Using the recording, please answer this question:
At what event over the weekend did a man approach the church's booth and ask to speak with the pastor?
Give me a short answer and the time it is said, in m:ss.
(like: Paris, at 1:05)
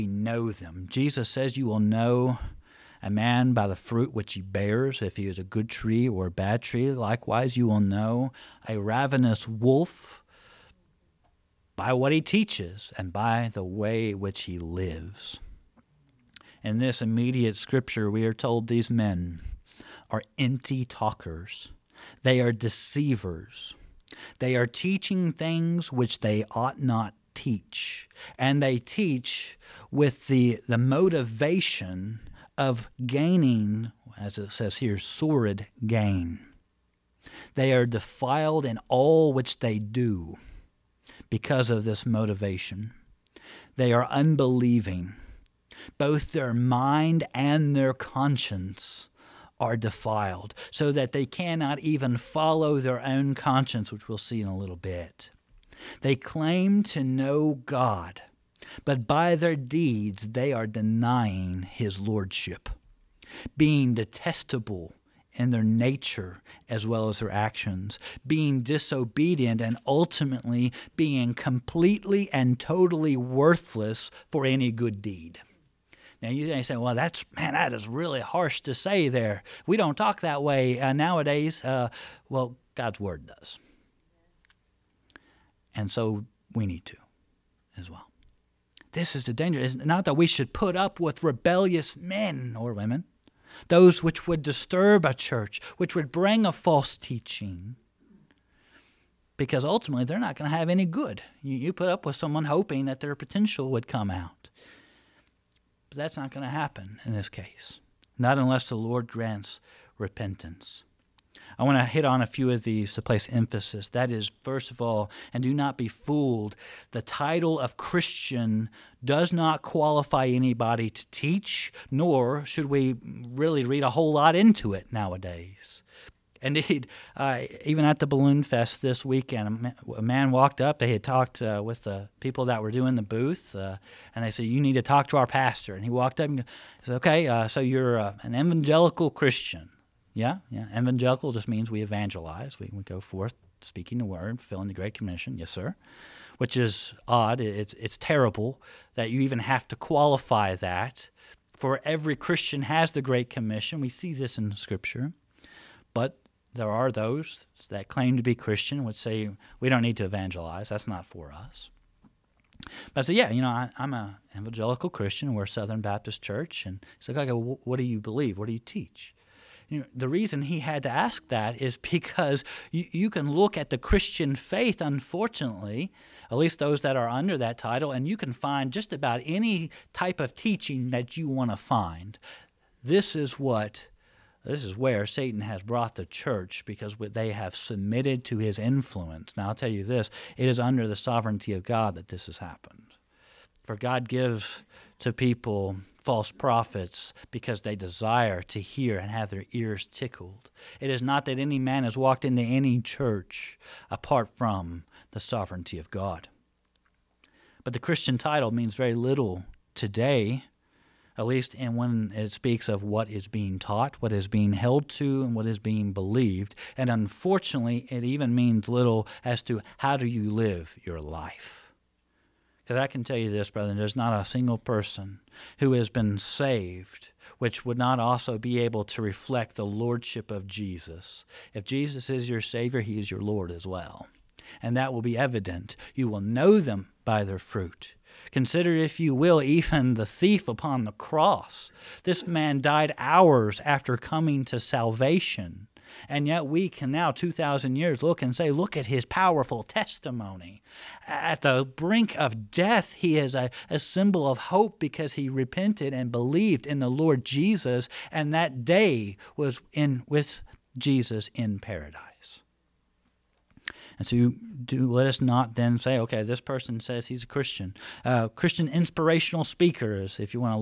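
Balloon Fest, at 2:08.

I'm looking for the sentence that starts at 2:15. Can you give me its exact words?
And he walked up and he said, Okay, uh, so you're uh, an evangelical Christian.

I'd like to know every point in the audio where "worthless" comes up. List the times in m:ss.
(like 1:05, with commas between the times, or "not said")
1:13.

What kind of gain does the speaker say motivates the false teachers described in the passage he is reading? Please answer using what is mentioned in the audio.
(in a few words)
sordid gain.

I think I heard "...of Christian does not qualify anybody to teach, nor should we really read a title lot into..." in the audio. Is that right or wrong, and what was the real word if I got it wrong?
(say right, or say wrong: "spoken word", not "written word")
wrong: "whole", not "title".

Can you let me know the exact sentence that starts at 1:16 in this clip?
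Now you say, well, that's man, that is really harsh to say.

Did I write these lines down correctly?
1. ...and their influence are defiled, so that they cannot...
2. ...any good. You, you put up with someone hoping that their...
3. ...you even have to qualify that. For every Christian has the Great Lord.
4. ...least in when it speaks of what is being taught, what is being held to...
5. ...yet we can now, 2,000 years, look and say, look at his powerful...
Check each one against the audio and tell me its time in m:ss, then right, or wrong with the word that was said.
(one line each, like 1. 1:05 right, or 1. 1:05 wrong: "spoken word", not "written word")
1. 0:47 wrong: "conscience", not "influence"
2. 1:40 right
3. 2:29 wrong: "Commission", not "Lord"
4. 3:31 right
5. 4:06 right.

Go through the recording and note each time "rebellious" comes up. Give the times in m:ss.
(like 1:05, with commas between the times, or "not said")
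1:31.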